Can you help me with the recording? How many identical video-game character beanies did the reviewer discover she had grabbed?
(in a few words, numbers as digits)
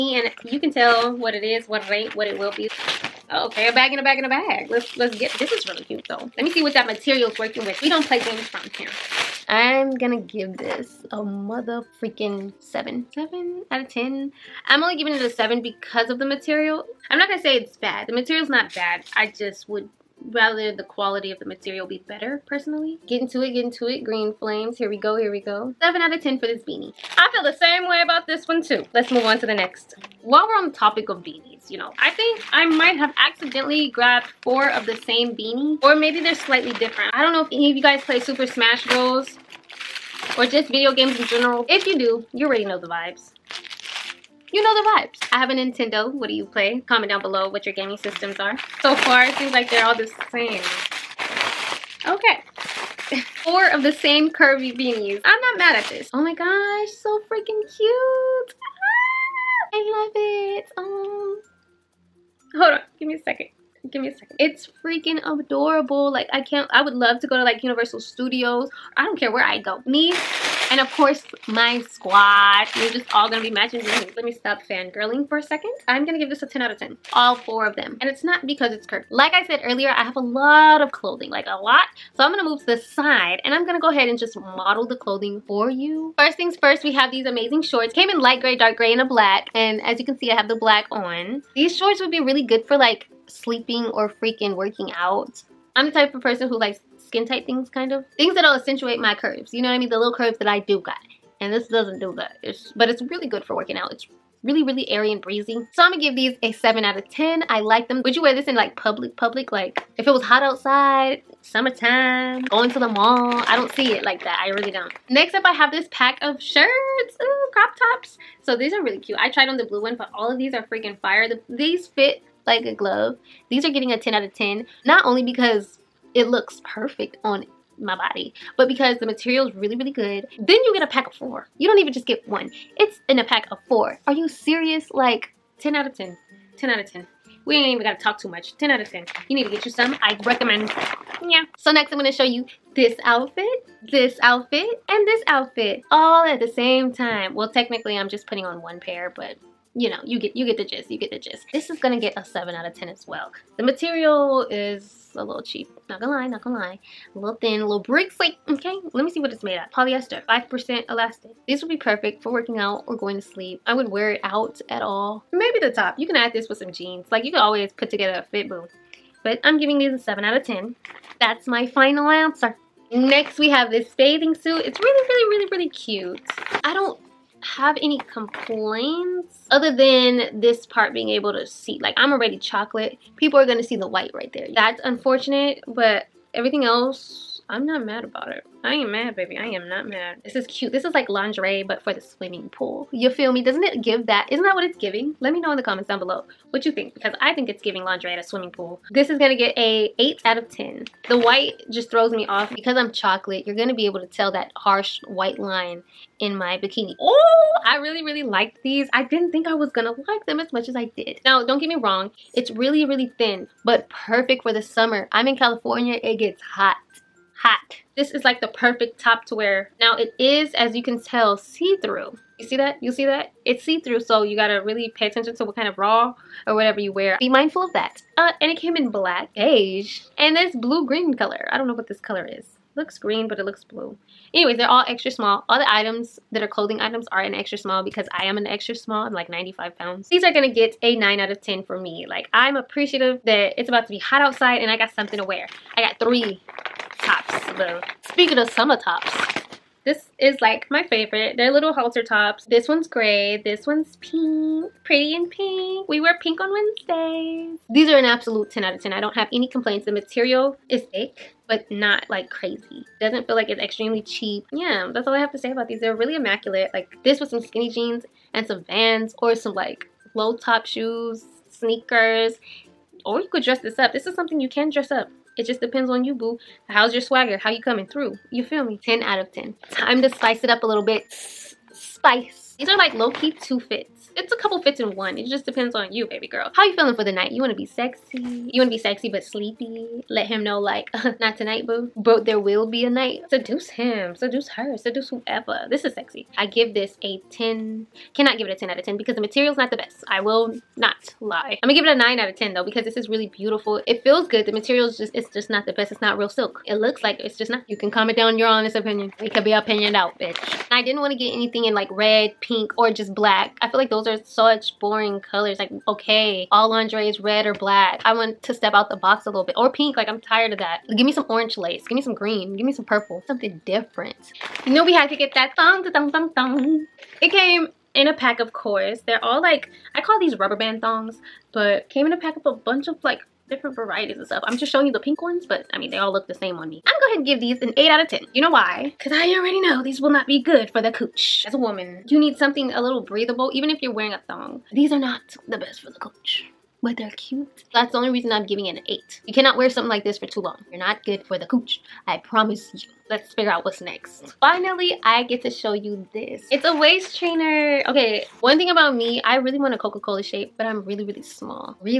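4.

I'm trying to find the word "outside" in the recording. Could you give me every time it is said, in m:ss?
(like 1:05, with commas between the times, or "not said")
1:50, 4:04.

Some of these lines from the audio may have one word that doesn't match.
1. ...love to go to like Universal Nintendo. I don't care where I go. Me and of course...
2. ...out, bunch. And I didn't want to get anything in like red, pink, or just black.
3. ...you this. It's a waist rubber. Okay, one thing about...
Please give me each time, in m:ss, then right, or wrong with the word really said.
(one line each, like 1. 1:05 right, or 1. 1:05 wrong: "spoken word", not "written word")
1. 1:06 wrong: "Studios", not "Nintendo"
2. 5:09 wrong: "bitch", not "bunch"
3. 5:55 wrong: "trainer", not "rubber".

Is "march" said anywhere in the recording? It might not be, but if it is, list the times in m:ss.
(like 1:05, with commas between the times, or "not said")
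not said.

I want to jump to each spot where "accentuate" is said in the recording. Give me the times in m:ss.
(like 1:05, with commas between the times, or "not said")
1:38.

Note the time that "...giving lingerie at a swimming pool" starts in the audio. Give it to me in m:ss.
3:17.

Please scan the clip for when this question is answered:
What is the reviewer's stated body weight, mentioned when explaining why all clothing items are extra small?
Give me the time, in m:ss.
3:59.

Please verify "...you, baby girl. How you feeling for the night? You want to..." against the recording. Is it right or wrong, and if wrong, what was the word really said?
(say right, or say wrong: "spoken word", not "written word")
right.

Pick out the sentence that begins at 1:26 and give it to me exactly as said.
First things first, we have these amazing shorts.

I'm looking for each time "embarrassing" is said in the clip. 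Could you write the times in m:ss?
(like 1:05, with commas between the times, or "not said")
not said.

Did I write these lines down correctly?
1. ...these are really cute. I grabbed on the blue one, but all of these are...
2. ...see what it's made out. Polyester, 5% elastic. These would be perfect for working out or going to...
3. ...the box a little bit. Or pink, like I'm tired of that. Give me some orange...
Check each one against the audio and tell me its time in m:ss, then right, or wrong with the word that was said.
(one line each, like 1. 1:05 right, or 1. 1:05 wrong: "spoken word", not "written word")
1. 1:58 wrong: "tried", not "grabbed"
2. 2:39 right
3. 5:18 right.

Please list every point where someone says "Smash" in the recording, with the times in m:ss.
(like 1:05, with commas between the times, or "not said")
0:38.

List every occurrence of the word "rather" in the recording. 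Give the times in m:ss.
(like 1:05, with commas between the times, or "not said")
0:20.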